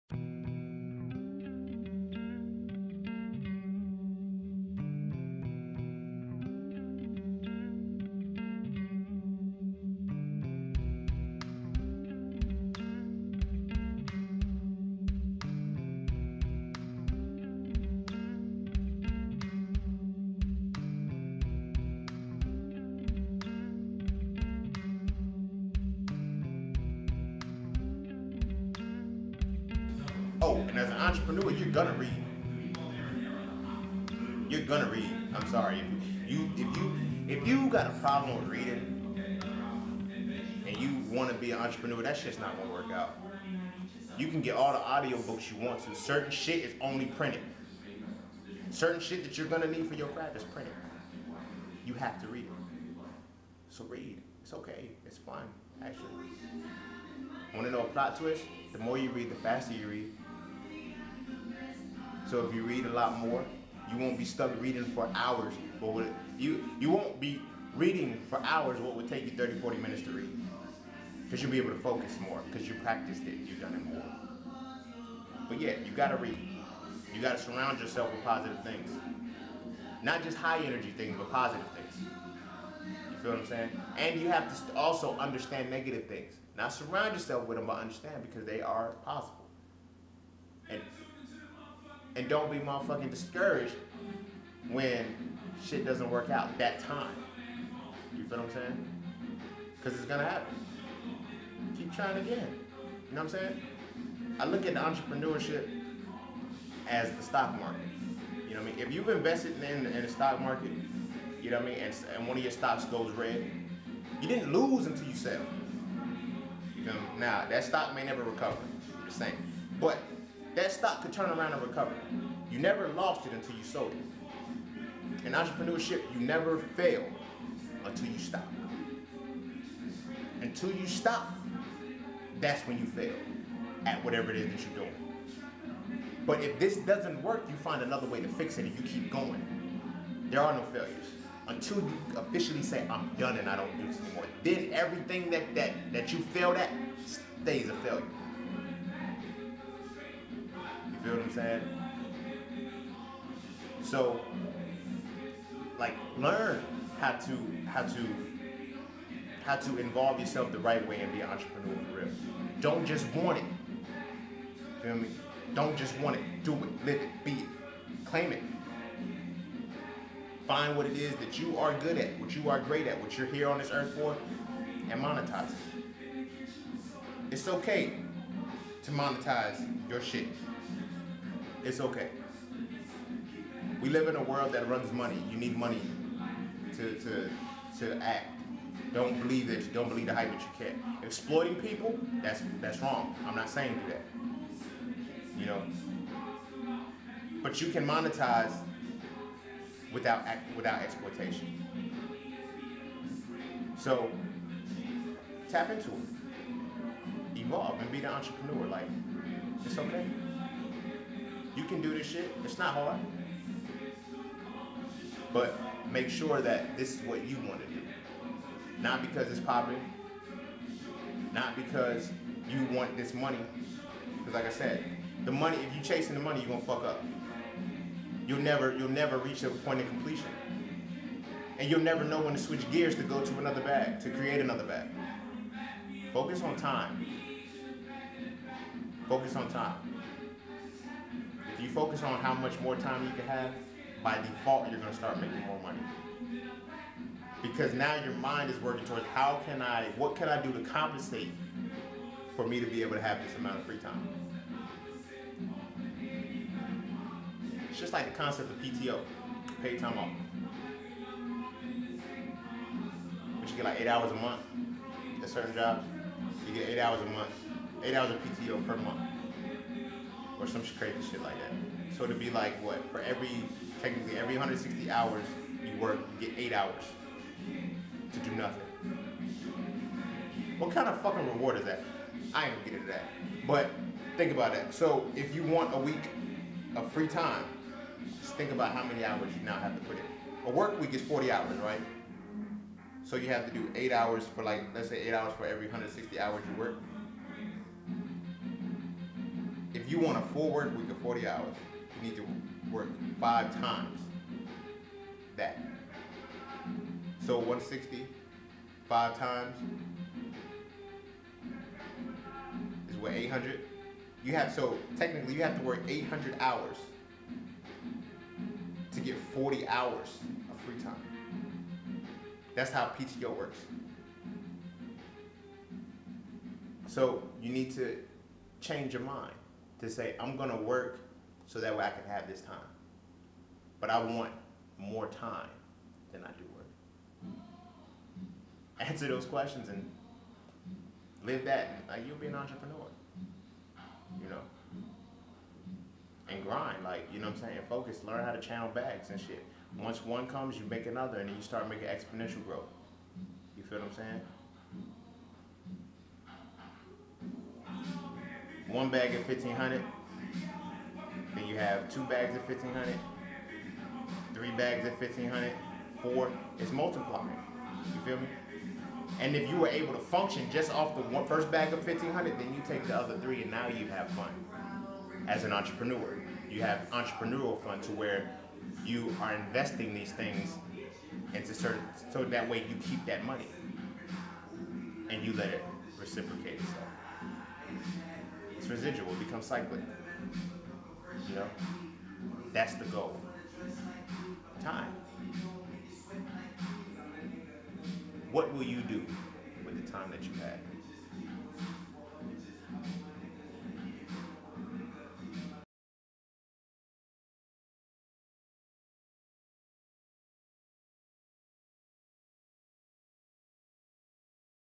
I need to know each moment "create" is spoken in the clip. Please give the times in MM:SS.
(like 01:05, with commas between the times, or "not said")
03:54.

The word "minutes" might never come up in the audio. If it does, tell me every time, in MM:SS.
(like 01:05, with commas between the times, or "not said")
01:09.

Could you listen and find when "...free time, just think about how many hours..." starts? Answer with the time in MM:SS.
04:46.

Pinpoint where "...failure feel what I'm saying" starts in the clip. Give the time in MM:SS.
02:27.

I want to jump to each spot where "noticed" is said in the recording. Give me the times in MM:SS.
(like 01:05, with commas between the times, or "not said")
not said.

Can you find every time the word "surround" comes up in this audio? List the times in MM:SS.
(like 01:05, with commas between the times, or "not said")
01:17, 01:26.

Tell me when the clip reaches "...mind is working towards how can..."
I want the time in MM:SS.
04:08.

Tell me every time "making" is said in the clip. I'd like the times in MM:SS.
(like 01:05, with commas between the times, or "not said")
04:05, 05:51.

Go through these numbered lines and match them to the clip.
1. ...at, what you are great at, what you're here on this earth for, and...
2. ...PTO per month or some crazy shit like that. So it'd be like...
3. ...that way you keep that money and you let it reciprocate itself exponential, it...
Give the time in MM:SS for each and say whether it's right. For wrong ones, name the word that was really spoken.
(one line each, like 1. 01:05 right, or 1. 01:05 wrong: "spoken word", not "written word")
1. 02:51 right
2. 04:28 right
3. 06:22 wrong: "residual", not "exponential".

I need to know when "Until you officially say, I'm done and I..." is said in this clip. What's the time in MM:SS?
02:21.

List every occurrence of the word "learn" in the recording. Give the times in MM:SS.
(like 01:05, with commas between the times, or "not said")
02:36, 05:48.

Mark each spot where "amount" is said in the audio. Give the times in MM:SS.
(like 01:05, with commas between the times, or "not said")
04:13.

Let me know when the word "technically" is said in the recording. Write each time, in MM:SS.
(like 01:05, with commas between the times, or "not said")
04:33, 05:14.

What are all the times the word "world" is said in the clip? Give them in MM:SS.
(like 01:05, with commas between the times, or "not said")
03:04.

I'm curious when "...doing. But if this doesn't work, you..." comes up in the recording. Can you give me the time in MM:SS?
02:14.